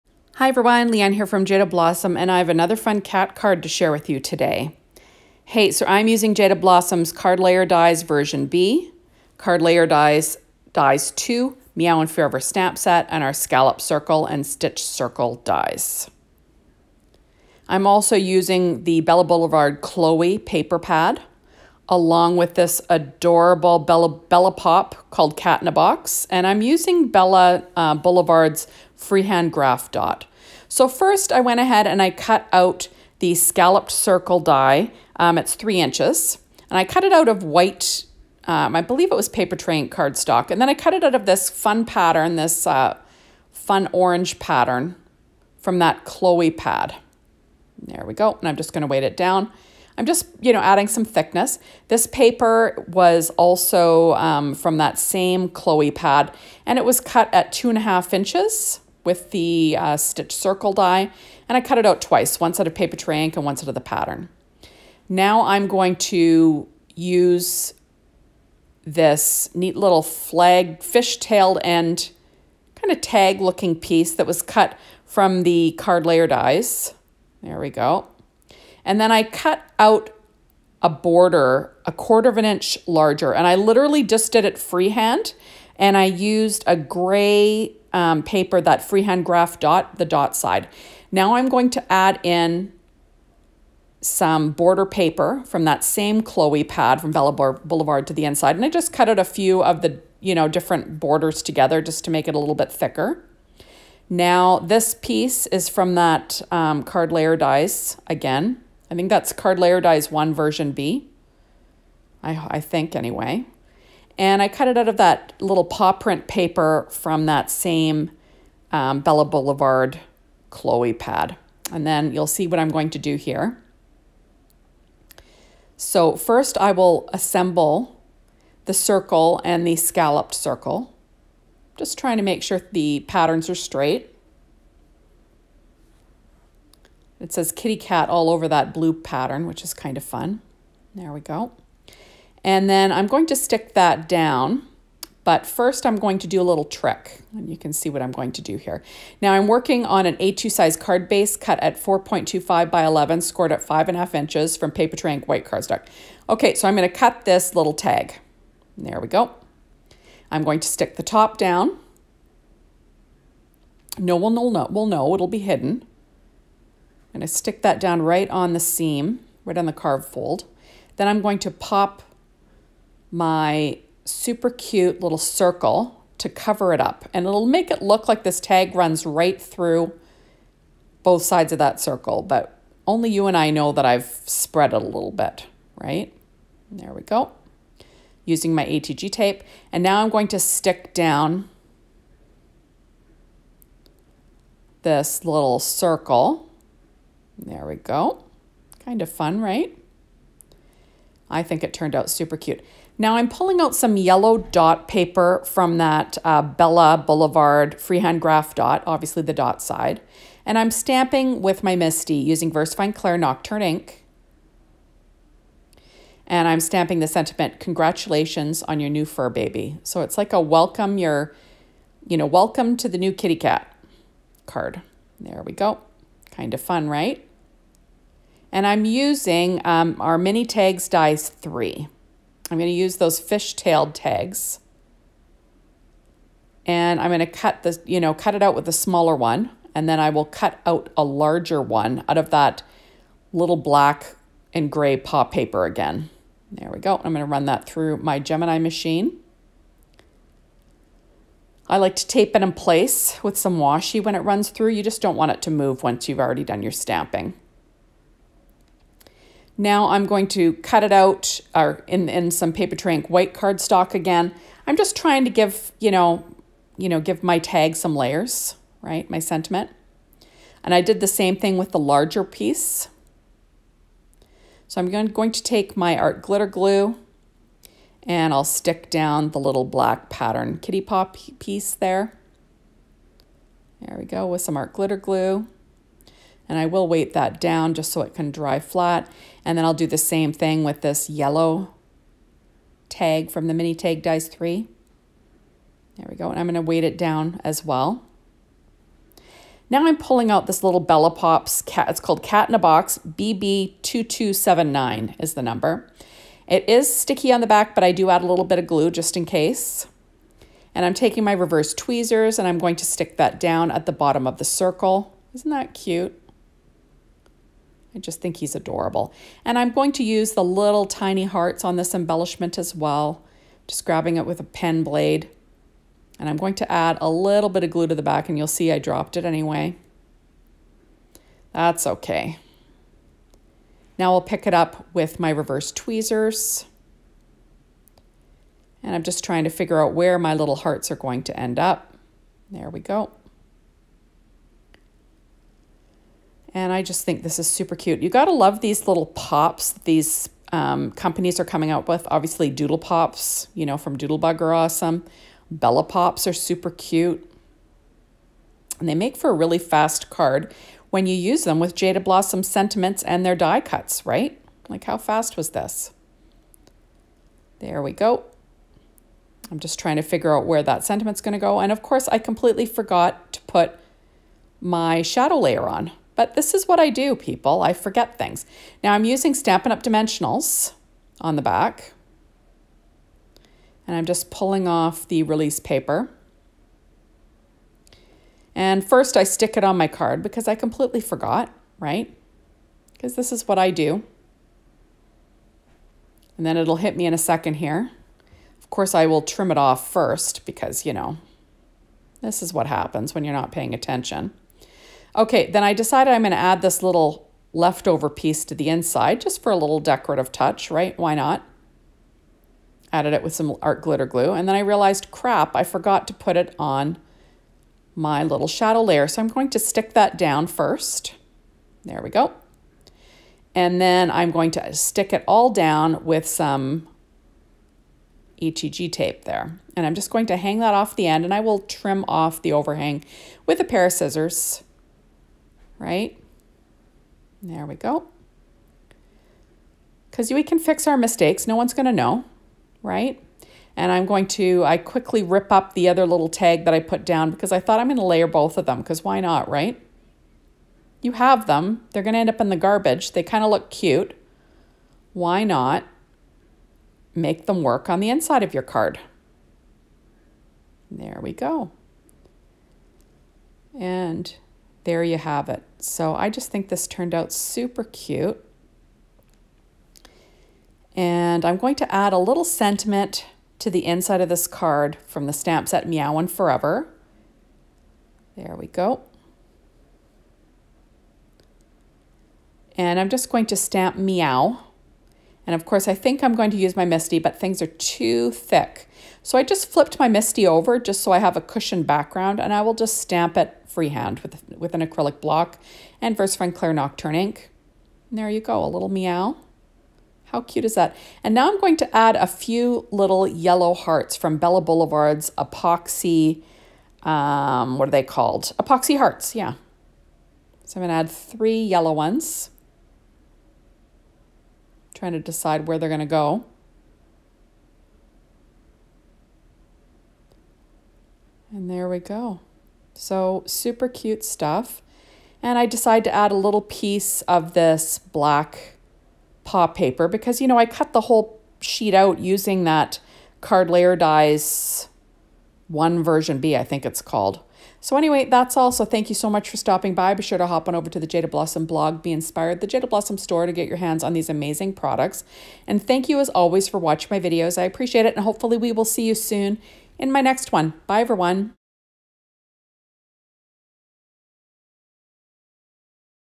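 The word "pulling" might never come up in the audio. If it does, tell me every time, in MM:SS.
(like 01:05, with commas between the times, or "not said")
03:23, 04:59, 06:24.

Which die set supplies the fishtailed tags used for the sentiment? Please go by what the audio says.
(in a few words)
Mini Tags Dies 3.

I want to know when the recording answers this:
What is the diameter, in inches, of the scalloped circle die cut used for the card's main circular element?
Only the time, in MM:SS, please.
00:35.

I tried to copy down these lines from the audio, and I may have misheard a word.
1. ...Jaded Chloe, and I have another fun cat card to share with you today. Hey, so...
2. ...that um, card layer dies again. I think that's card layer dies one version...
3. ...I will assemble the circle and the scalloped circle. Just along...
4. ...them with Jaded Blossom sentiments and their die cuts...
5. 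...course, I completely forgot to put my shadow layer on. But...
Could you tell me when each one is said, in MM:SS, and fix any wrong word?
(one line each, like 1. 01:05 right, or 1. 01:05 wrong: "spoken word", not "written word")
1. 00:01 wrong: "Blossom", not "Chloe"
2. 01:45 right
3. 02:06 wrong: "trying", not "along"
4. 06:01 right
5. 06:11 right.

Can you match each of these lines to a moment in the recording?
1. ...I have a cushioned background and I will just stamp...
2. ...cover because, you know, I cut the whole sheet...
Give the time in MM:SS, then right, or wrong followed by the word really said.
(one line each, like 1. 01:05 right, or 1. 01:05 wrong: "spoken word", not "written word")
1. 08:11 right
2. 08:49 wrong: "paper", not "cover".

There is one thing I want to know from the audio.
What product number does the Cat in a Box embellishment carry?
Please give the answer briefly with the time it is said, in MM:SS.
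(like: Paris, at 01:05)
BB2279, at 05:03.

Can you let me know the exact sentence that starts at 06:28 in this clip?
And first I stick it on my card because I completely forgot, right?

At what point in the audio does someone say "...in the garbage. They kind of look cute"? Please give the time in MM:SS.
07:32.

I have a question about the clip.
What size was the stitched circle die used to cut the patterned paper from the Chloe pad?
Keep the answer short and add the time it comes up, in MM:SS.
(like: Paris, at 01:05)
2.5 inches, at 00:57.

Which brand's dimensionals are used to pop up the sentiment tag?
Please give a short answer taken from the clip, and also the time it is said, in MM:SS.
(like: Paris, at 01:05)
Stampin' Up!, at 06:19.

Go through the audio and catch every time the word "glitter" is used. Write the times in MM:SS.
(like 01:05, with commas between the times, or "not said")
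04:36, 04:44, 06:53.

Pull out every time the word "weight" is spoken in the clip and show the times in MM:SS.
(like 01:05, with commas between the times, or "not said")
00:48, 04:46, 04:56.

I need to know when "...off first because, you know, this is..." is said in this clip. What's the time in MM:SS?
06:39.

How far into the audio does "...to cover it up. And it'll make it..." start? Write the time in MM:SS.
02:56.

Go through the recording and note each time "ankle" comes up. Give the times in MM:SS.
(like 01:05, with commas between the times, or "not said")
not said.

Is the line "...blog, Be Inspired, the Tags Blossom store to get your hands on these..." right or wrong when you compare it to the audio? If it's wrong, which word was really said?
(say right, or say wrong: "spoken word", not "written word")
wrong: "Jaded", not "Tags".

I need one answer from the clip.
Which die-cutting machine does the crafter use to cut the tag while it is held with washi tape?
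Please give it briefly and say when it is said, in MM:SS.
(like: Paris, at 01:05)
Gemini, at 04:08.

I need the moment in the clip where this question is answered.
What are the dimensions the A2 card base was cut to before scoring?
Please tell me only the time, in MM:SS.
02:31.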